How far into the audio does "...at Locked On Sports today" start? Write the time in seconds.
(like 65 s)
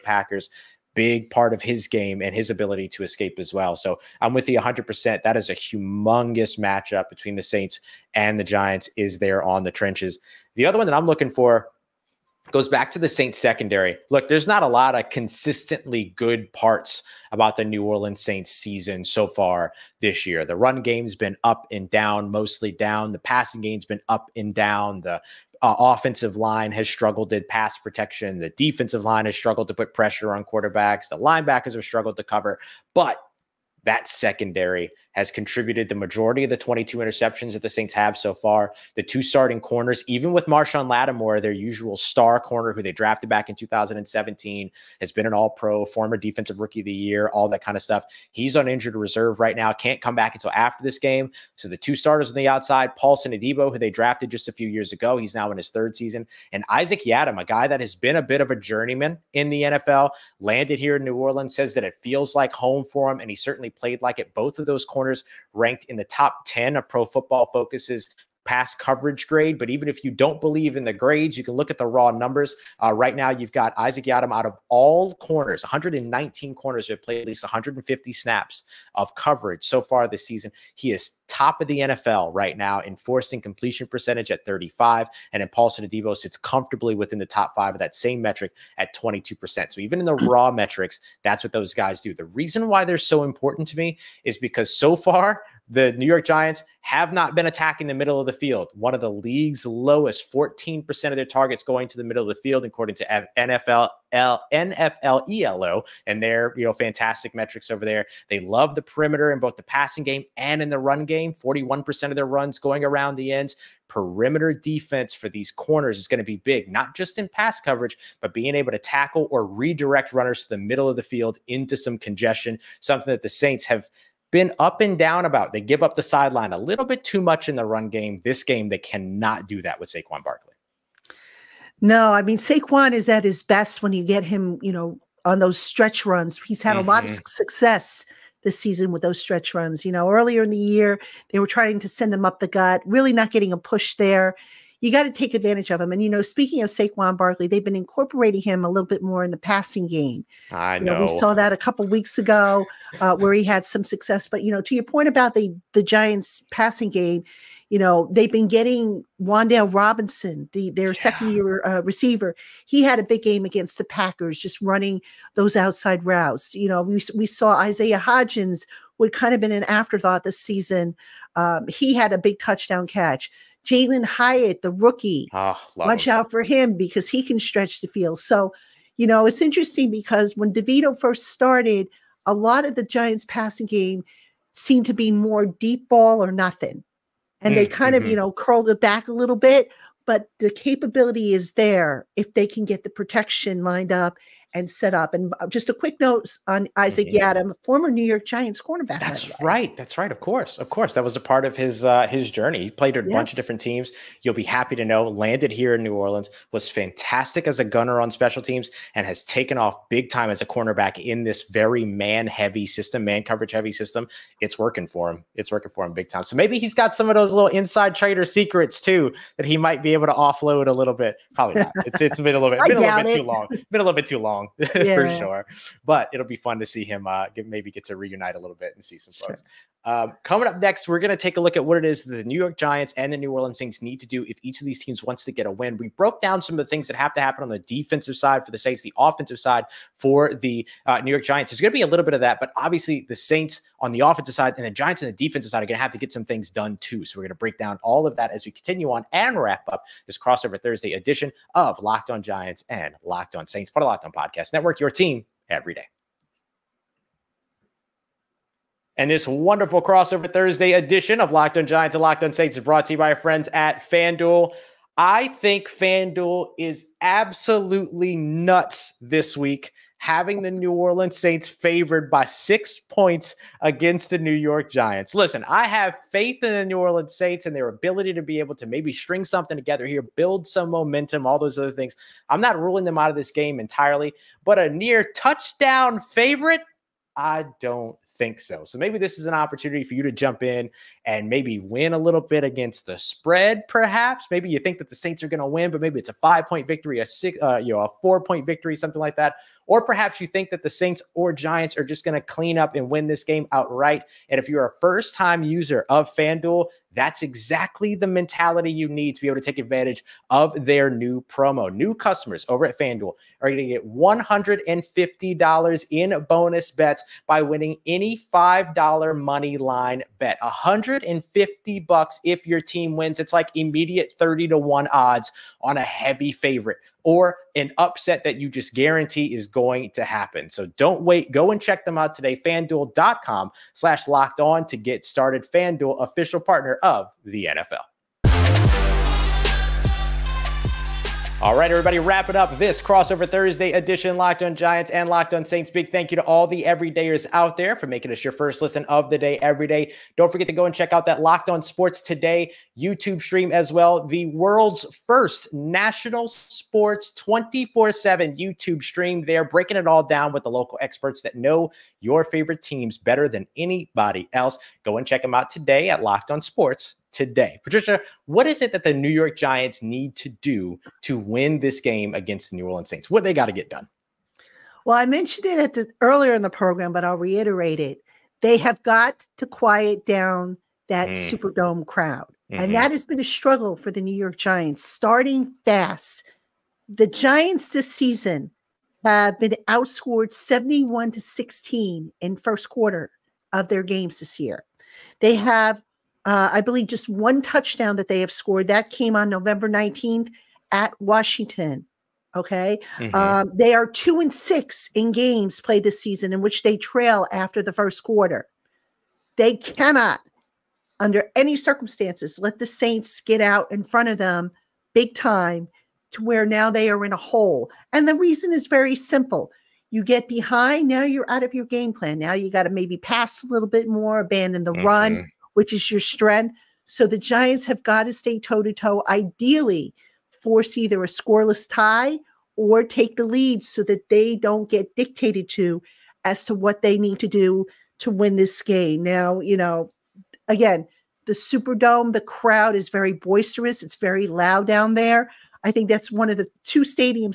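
365 s.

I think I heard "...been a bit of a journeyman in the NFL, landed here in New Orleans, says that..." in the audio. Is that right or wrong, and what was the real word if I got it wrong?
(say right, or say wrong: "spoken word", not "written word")
right.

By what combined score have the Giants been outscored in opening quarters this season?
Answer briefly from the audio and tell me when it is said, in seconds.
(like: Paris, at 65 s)
71 to 16, at 390 s.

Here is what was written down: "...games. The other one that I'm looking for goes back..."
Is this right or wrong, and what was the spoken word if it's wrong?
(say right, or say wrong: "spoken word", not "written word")
wrong: "trenches", not "games".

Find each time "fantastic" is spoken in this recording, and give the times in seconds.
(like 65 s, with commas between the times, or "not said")
106 s, 206 s.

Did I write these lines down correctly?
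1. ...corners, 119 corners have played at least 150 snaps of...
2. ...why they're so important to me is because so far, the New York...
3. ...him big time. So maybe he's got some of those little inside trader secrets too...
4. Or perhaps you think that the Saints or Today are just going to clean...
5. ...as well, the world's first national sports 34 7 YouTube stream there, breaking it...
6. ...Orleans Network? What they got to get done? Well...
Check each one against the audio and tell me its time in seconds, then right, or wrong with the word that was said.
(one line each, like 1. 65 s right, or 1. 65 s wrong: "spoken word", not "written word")
1. 75 s right
2. 92 s right
3. 215 s right
4. 299 s wrong: "Giants", not "Today"
5. 353 s wrong: "24", not "34"
6. 372 s wrong: "Saints", not "Network".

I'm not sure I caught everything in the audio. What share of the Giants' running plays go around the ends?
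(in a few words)
41%.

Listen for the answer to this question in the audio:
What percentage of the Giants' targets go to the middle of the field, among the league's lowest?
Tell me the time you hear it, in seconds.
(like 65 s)
100 s.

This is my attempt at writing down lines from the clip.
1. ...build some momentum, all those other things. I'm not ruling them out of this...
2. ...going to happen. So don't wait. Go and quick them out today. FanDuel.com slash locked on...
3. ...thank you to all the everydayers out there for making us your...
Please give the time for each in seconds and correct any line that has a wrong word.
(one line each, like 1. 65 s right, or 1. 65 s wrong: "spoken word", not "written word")
1. 280 s right
2. 329 s wrong: "check", not "quick"
3. 345 s right.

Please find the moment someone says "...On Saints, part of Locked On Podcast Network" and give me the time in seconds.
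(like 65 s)
253 s.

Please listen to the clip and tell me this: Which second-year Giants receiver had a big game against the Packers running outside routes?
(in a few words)
Wan'Dale Robinson.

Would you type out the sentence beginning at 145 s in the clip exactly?
And you know, speaking of Saquon Barkley, they've been incorporating him a little bit more in the passing game.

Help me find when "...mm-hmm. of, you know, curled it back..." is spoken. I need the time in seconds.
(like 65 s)
187 s.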